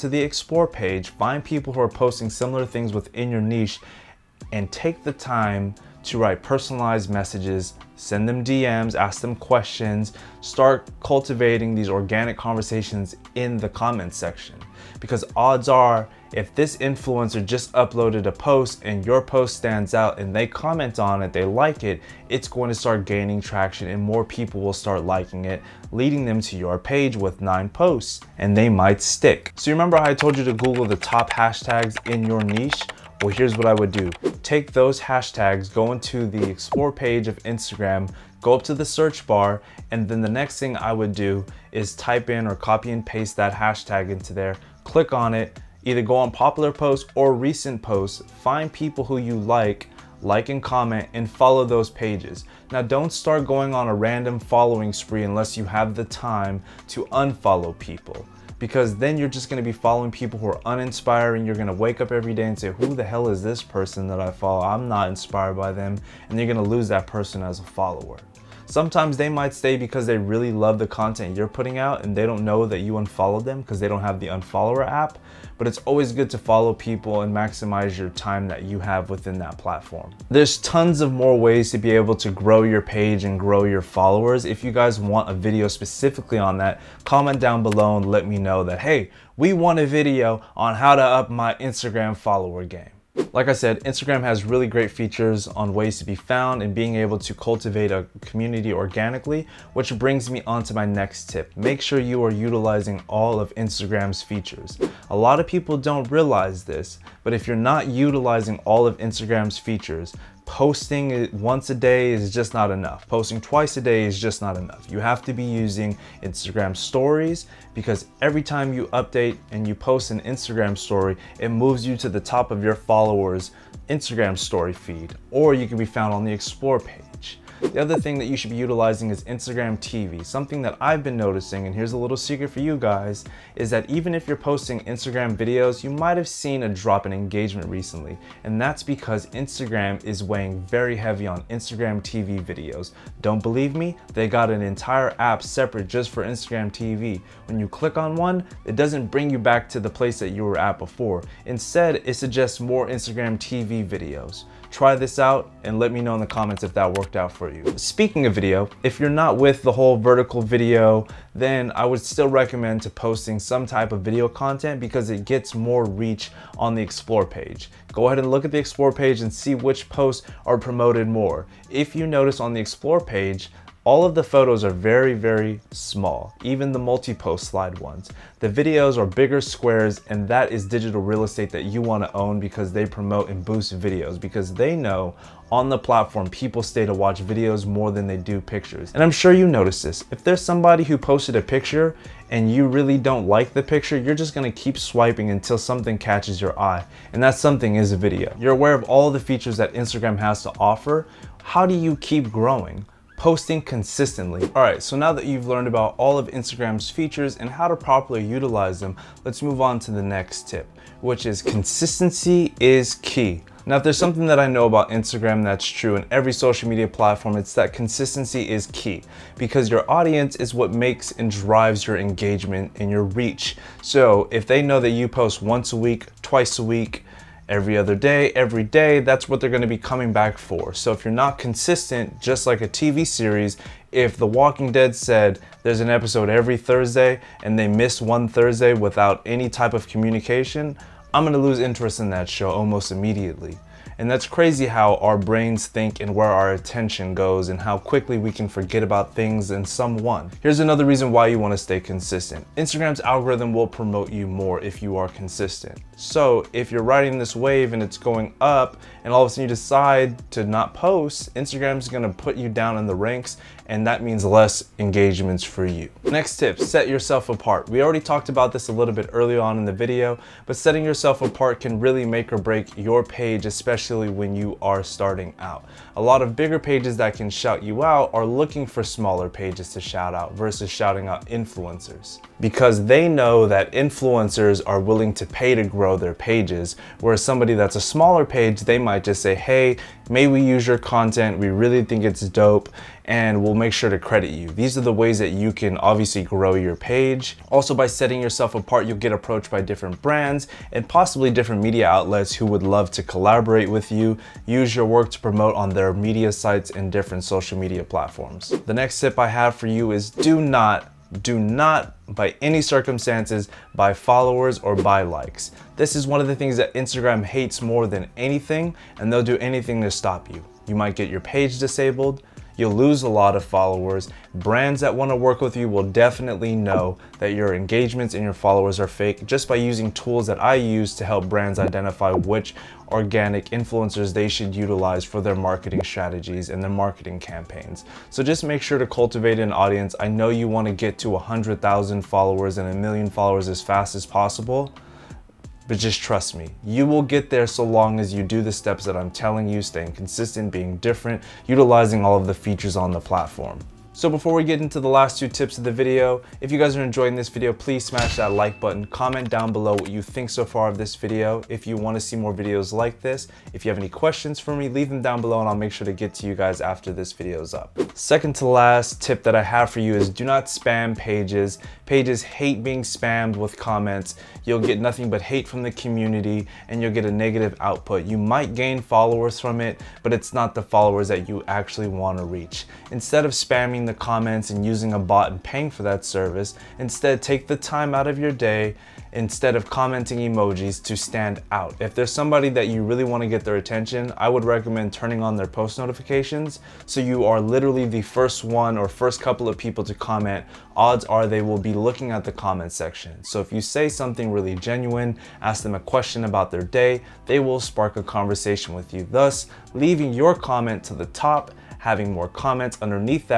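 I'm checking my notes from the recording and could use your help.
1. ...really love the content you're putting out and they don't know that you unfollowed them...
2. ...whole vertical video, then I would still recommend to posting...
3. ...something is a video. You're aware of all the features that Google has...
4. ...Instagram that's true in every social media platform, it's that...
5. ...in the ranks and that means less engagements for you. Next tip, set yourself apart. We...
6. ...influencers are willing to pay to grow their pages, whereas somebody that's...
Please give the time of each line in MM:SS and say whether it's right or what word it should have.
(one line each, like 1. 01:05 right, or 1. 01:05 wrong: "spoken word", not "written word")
1. 01:10 right
2. 02:39 right
3. 03:17 wrong: "Instagram", not "Google"
4. 03:34 right
5. 04:22 right
6. 04:43 right.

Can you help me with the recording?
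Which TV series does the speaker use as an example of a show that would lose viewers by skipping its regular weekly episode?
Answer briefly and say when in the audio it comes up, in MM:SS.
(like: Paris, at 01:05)
The Walking Dead, at 03:54.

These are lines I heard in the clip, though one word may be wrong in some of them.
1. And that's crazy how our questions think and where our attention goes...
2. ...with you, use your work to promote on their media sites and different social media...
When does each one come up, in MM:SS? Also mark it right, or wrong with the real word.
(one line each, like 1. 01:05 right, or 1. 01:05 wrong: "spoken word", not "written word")
1. 04:03 wrong: "brains", not "questions"
2. 05:03 right.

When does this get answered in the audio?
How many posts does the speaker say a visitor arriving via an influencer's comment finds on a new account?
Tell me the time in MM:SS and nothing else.
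00:27.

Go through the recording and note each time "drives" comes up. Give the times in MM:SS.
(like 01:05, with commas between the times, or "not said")
03:41.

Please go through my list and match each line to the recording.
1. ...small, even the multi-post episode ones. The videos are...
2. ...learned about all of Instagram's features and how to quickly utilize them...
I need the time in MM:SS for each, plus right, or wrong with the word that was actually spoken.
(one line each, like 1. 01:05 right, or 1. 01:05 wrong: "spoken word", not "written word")
1. 02:55 wrong: "slide", not "episode"
2. 03:25 wrong: "properly", not "quickly".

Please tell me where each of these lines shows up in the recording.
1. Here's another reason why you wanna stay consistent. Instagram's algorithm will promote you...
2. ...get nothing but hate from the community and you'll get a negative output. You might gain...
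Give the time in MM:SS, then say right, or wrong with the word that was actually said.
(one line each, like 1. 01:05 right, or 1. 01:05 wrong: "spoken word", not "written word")
1. 04:10 right
2. 06:14 right.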